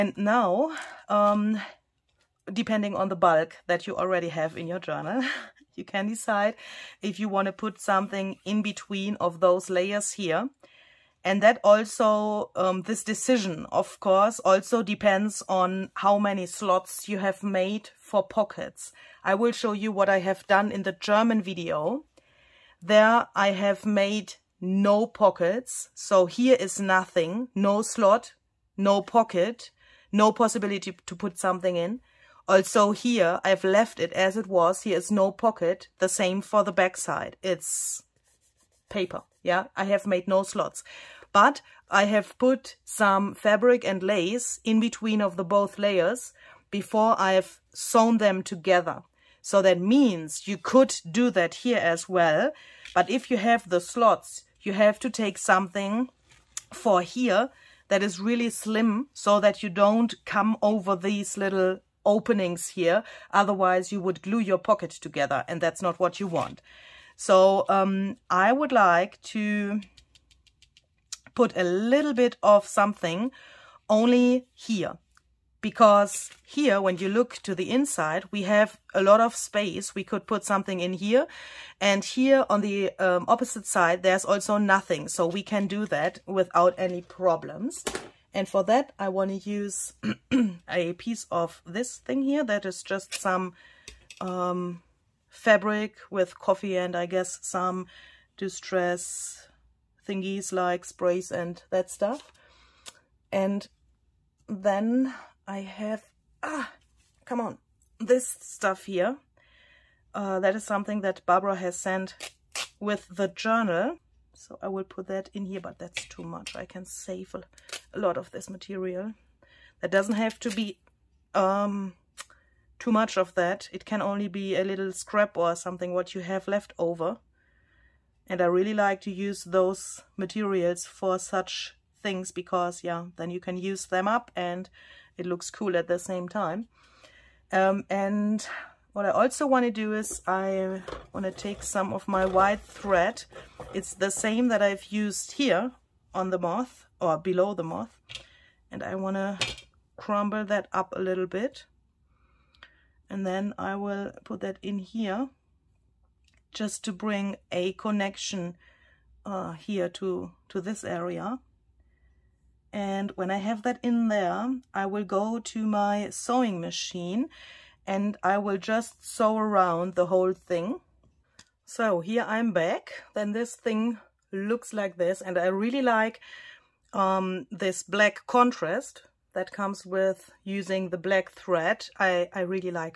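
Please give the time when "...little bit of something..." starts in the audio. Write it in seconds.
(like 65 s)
71 s.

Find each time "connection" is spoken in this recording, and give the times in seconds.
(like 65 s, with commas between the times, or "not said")
157 s.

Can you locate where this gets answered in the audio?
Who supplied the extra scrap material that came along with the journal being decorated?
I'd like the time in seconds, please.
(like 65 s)
111 s.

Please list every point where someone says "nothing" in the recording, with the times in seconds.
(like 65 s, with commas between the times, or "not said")
26 s, 84 s.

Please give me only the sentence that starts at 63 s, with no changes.
Otherwise, you would glue your pocket together and that's not what you want.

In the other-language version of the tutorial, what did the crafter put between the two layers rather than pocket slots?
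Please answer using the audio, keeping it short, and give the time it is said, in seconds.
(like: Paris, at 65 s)
Fabric and lace, at 43 s.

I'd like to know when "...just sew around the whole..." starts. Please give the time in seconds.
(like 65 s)
168 s.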